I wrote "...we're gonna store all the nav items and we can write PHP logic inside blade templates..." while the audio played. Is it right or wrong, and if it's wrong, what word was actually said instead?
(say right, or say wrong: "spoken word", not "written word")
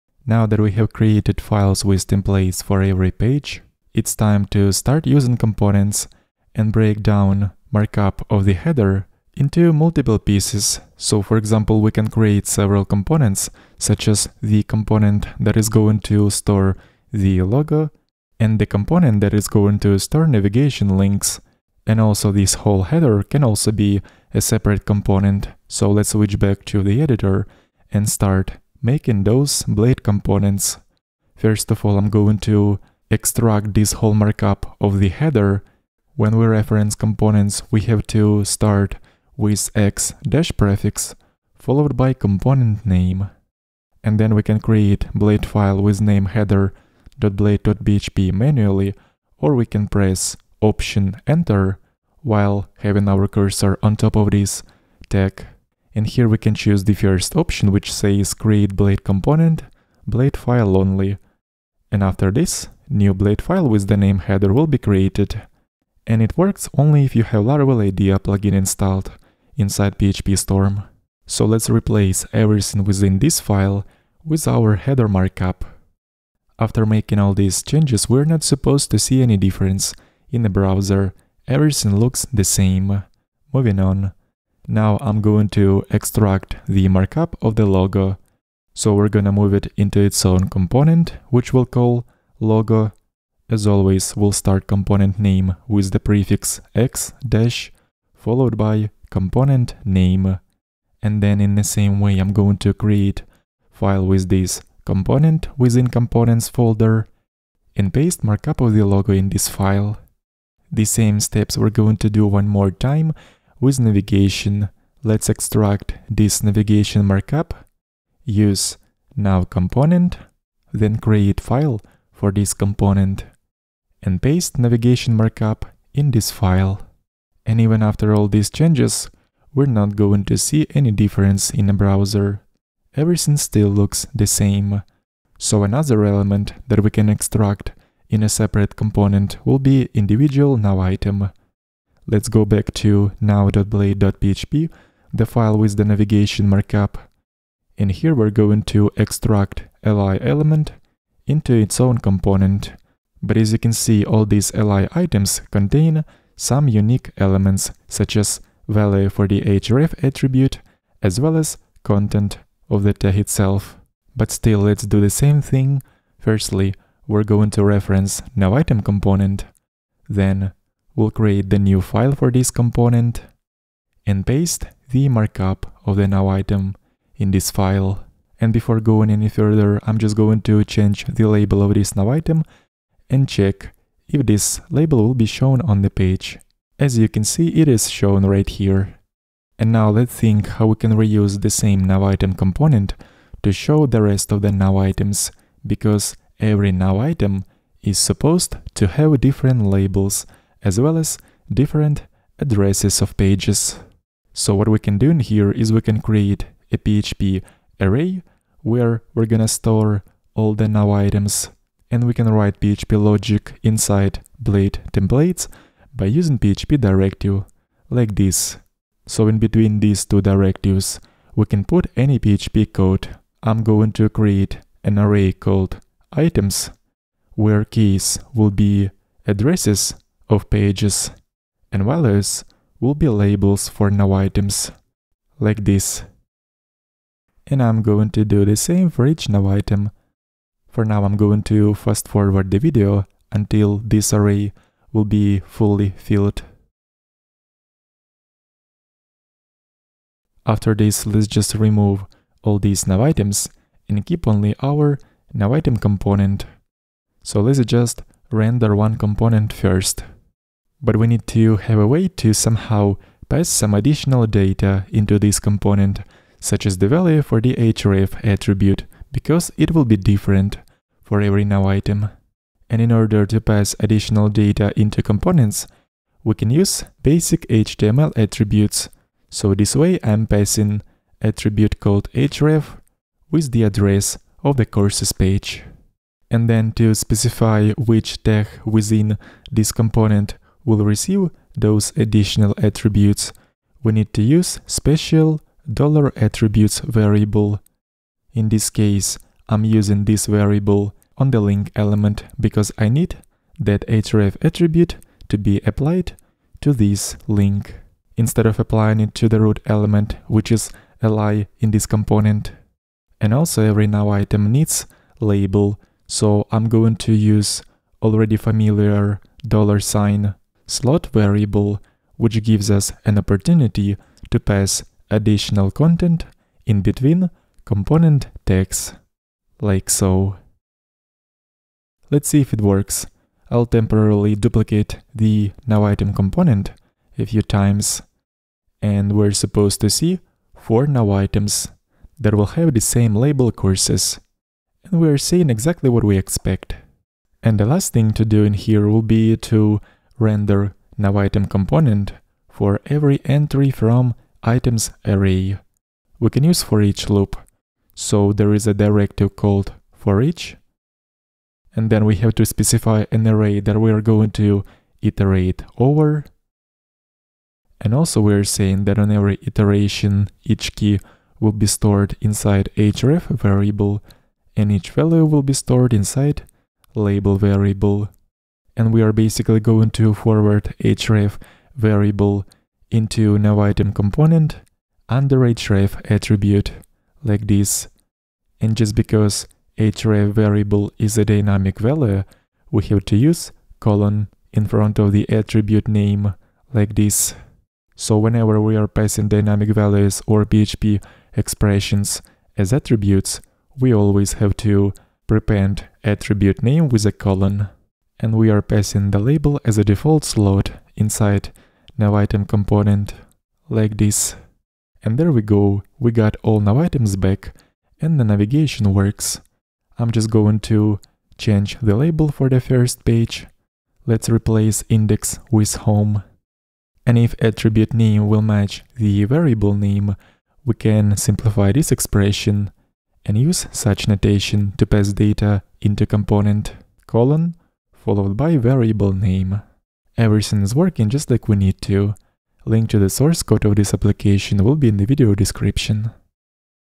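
right.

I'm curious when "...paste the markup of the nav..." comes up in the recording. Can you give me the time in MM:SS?
02:54.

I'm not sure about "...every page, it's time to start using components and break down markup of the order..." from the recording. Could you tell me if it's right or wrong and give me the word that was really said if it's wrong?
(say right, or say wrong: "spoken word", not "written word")
wrong: "header", not "order".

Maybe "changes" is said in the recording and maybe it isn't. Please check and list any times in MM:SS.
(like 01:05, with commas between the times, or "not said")
01:17, 02:08, 03:00, 07:01.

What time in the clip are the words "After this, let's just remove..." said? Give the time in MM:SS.
04:10.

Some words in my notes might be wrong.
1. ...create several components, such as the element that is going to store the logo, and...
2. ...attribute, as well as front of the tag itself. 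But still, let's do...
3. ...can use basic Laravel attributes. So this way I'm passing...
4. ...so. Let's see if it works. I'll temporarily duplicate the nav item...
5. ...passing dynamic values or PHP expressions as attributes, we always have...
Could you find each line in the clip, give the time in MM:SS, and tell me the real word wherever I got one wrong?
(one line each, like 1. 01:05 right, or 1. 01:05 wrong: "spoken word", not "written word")
1. 00:12 wrong: "component", not "element"
2. 02:40 wrong: "content", not "front"
3. 04:36 wrong: "HTML", not "Laravel"
4. 05:29 right
5. 06:38 right.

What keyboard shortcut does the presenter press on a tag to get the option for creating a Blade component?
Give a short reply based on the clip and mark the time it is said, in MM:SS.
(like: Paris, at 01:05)
Option Enter, at 00:50.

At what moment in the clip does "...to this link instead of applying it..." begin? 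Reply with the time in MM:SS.
05:06.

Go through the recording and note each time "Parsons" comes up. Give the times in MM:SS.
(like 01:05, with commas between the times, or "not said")
not said.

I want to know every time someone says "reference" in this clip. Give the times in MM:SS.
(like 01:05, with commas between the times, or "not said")
00:36, 02:47.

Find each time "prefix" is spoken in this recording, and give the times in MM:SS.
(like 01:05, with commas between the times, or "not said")
00:40, 01:35.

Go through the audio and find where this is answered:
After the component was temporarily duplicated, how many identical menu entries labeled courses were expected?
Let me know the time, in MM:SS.
05:40.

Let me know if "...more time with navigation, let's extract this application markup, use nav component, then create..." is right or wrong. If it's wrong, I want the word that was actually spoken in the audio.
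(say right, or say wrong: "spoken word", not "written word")
wrong: "navigation", not "application".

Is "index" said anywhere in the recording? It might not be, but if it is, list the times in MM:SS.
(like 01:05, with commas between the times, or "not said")
07:04.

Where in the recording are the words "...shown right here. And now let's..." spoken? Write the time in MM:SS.
03:07.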